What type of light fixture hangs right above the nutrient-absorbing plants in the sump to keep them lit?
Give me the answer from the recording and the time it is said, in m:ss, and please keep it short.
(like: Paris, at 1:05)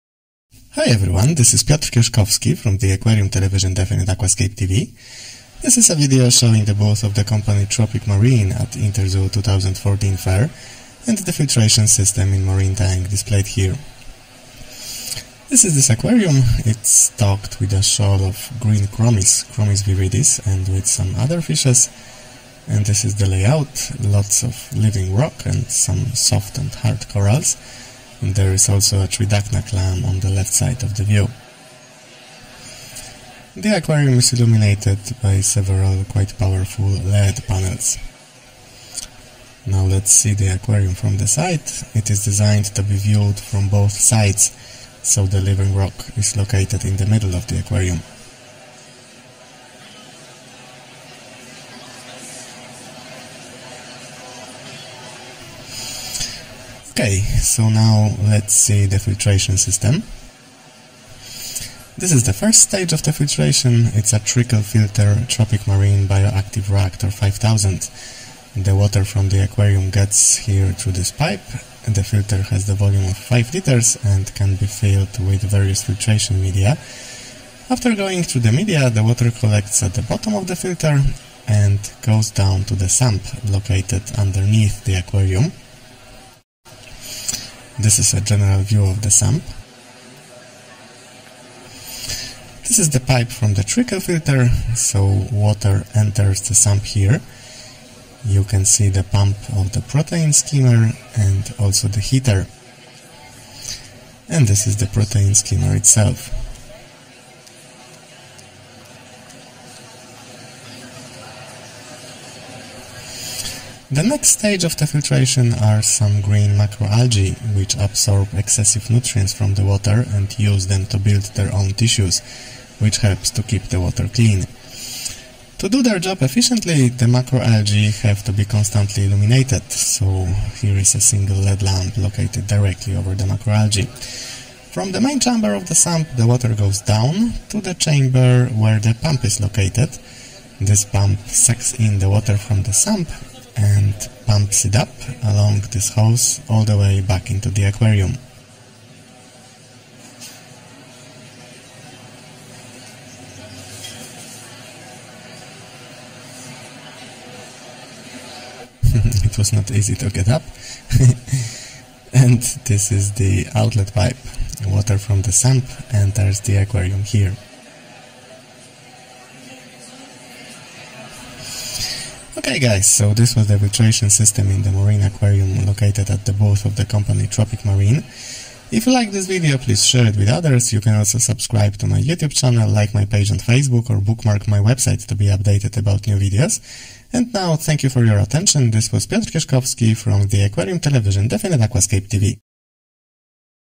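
single LED lamp, at 2:11.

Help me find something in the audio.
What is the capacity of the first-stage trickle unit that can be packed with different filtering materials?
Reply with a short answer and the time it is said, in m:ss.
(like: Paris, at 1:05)
5 liters, at 1:13.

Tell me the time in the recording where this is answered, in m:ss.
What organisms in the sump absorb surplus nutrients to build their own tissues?
1:56.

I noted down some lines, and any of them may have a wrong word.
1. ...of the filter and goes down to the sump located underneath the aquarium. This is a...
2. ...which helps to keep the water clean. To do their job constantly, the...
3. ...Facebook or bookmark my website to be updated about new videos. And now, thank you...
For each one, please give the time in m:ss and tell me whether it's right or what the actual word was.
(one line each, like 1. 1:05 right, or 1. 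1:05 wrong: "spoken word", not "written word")
1. 1:20 right
2. 2:02 wrong: "efficiently", not "constantly"
3. 3:03 right.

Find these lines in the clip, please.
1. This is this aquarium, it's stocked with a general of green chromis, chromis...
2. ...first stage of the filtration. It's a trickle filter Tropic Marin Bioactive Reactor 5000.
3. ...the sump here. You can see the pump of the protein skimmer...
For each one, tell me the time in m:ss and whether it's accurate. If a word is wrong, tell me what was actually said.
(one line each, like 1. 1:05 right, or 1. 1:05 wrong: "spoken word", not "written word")
1. 0:15 wrong: "shoal", not "general"
2. 1:02 right
3. 1:36 right.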